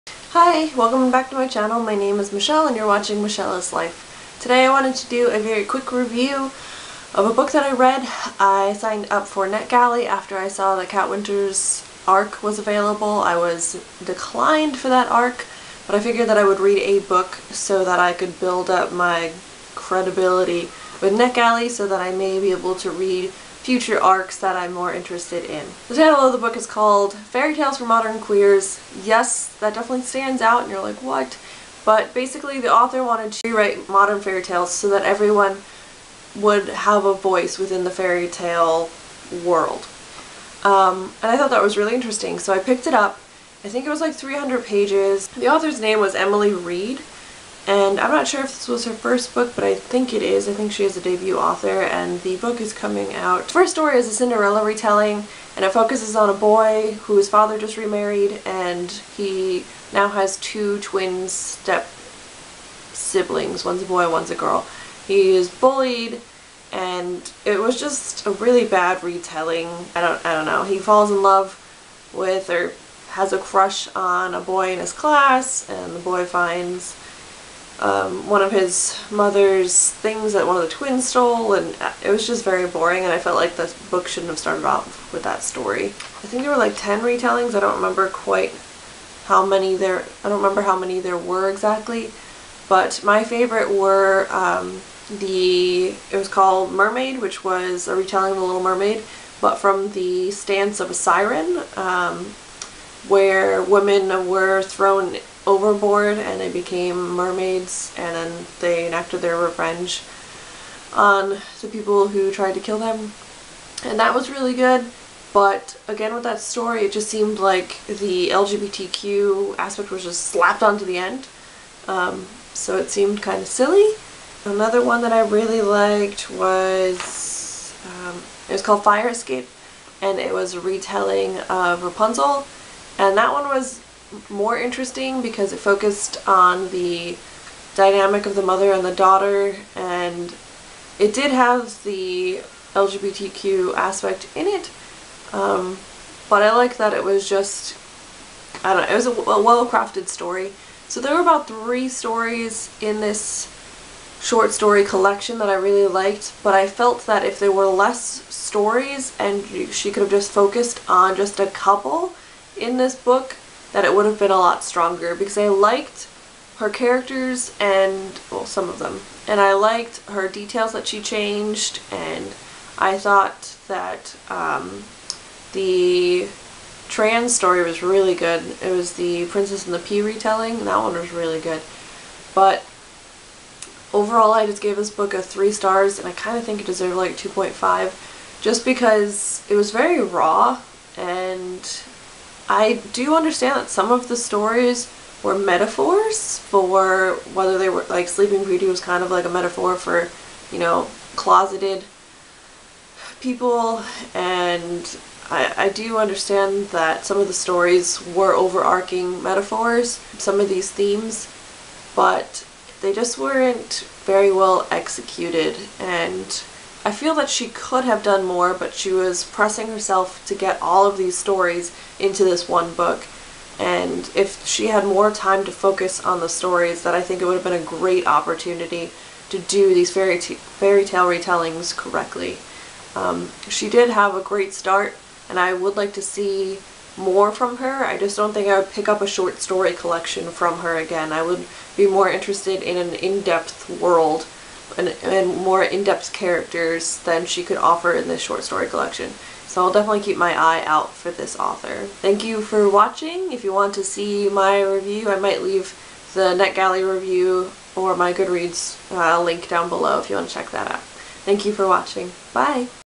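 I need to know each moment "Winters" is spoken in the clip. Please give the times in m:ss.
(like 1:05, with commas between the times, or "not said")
0:11.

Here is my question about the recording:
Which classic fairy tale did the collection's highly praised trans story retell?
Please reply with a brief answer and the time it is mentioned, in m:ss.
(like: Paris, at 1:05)
The Princess and the Pea, at 2:59.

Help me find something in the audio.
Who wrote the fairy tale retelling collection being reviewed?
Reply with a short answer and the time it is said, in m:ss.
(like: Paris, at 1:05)
Emily Reed, at 0:46.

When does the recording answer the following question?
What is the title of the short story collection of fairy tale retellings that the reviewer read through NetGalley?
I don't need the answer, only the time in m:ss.
0:27.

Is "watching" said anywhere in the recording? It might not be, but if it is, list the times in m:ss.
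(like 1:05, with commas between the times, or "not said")
0:02, 4:12, 4:21.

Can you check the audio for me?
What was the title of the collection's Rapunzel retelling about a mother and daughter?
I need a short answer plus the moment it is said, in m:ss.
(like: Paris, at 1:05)
Fire Escape, at 2:08.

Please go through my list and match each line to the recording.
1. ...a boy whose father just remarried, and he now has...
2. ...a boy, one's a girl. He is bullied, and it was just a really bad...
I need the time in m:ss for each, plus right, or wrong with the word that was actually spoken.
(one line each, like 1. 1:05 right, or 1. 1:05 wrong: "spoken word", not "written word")
1. 0:56 right
2. 1:03 right.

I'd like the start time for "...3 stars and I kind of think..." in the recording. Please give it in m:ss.
3:05.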